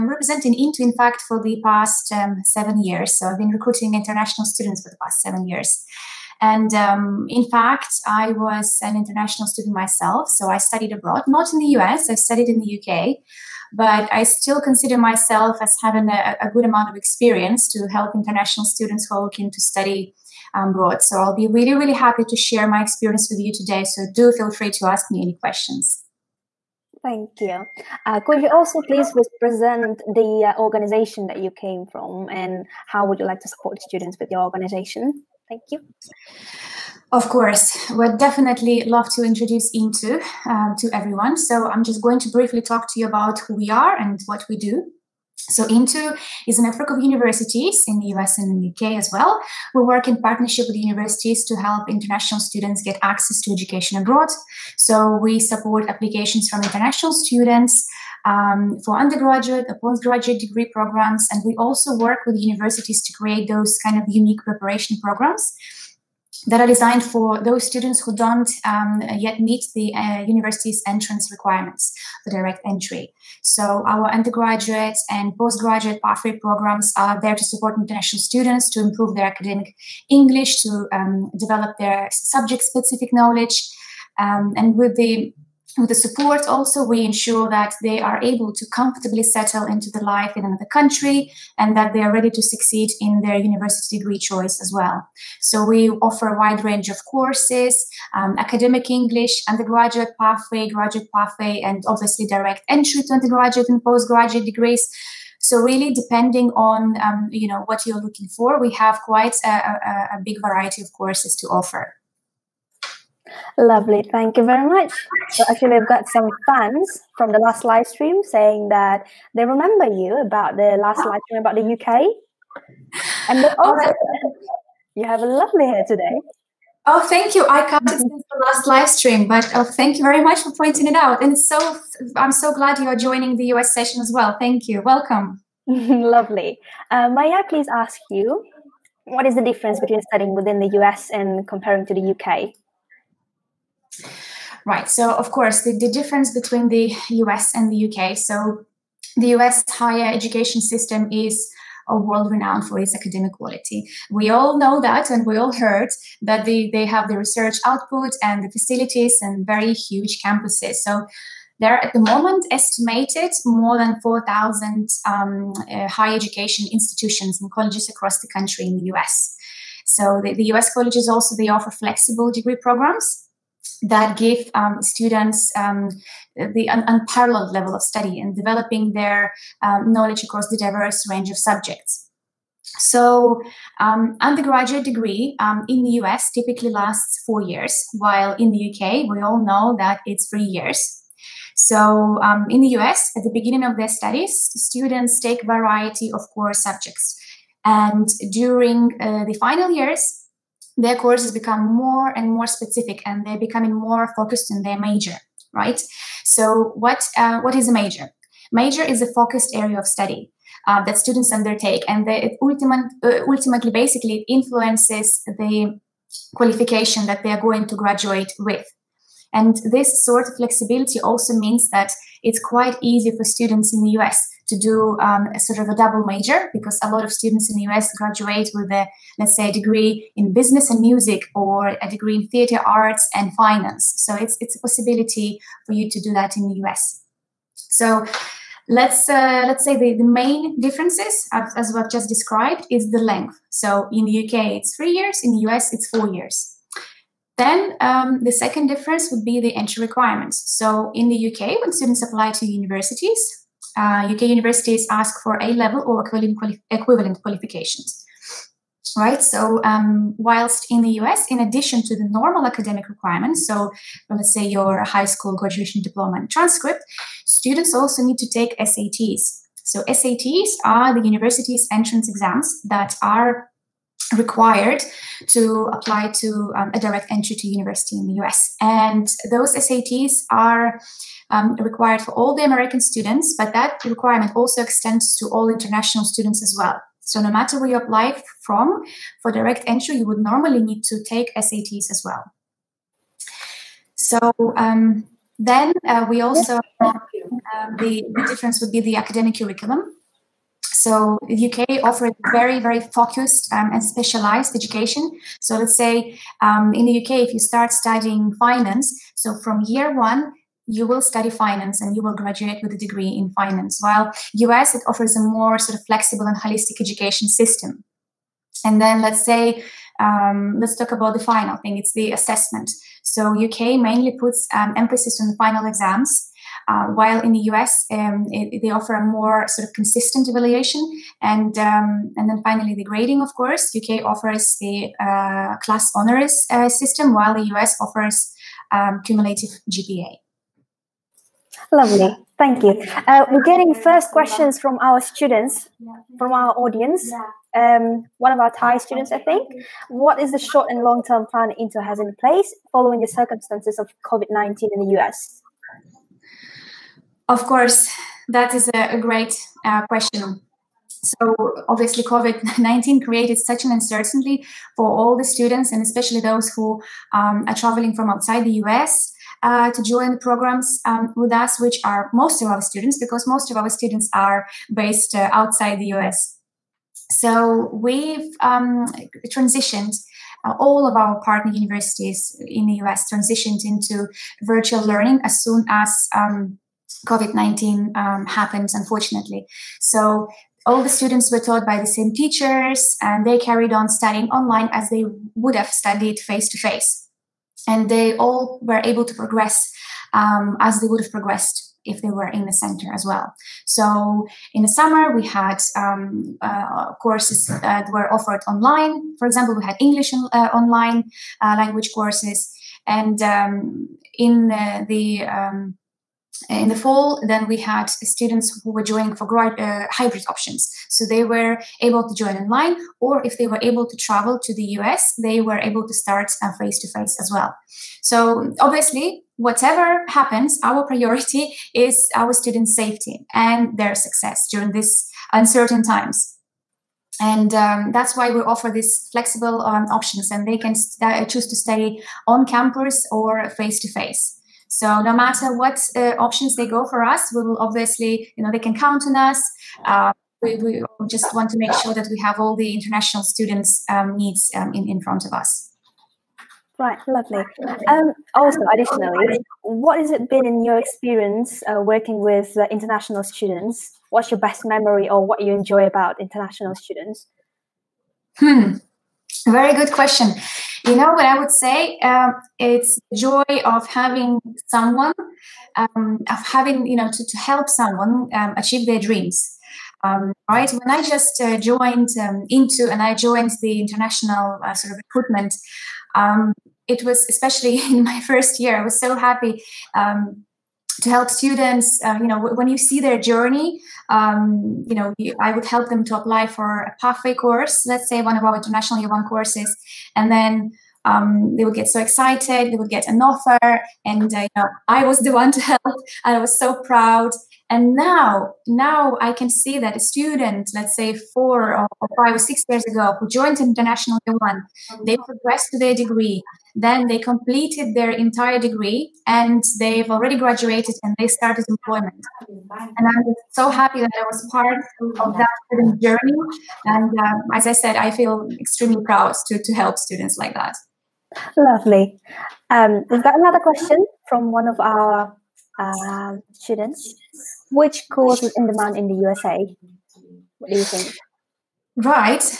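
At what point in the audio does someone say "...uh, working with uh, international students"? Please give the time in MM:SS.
07:41.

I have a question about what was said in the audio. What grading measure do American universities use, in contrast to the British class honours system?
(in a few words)
cumulative GPA.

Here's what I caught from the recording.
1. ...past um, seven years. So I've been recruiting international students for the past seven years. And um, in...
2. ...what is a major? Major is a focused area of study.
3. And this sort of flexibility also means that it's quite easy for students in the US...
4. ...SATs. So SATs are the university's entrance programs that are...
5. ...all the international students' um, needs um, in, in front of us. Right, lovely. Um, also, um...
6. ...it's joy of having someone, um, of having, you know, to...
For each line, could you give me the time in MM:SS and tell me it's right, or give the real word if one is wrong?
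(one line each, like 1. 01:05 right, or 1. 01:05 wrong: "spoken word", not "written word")
1. 00:01 right
2. 03:27 right
3. 03:39 right
4. 04:28 wrong: "exams", not "programs"
5. 07:32 right
6. 07:52 right.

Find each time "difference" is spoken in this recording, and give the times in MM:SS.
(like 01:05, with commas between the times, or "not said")
02:19, 02:25, 04:00, 04:08, 04:58.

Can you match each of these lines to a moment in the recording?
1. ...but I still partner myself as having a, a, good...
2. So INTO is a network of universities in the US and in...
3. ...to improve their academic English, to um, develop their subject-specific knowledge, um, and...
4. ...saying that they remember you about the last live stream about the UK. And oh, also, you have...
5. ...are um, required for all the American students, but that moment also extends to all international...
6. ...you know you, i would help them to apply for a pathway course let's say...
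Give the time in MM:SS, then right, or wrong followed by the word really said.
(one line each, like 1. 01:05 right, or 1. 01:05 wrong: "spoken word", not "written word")
1. 00:13 wrong: "consider", not "partner"
2. 00:45 right
3. 01:18 right
4. 01:58 right
5. 04:40 wrong: "requirement", not "moment"
6. 08:14 right.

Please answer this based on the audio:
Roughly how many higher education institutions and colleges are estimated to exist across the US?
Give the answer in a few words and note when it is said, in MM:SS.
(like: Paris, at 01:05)
more than 4,000, at 02:43.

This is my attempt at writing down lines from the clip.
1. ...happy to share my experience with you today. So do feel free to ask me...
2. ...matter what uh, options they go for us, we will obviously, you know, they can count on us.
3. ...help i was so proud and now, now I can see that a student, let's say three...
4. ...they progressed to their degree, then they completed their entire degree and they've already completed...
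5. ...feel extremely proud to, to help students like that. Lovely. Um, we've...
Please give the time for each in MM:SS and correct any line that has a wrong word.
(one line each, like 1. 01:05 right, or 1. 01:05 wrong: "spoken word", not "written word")
1. 00:21 right
2. 07:25 right
3. 08:25 wrong: "four", not "three"
4. 08:35 wrong: "graduated", not "completed"
5. 08:48 right.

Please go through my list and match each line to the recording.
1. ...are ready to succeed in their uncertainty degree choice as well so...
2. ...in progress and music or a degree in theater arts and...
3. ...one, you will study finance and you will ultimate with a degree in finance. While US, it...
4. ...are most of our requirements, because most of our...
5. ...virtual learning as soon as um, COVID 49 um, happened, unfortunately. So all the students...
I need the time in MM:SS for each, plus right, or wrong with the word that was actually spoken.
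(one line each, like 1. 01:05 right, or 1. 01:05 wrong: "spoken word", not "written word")
1. 01:32 wrong: "university", not "uncertainty"
2. 03:50 wrong: "business", not "progress"
3. 05:09 wrong: "graduate", not "ultimate"
4. 06:11 wrong: "students", not "requirements"
5. 06:24 wrong: "19", not "49".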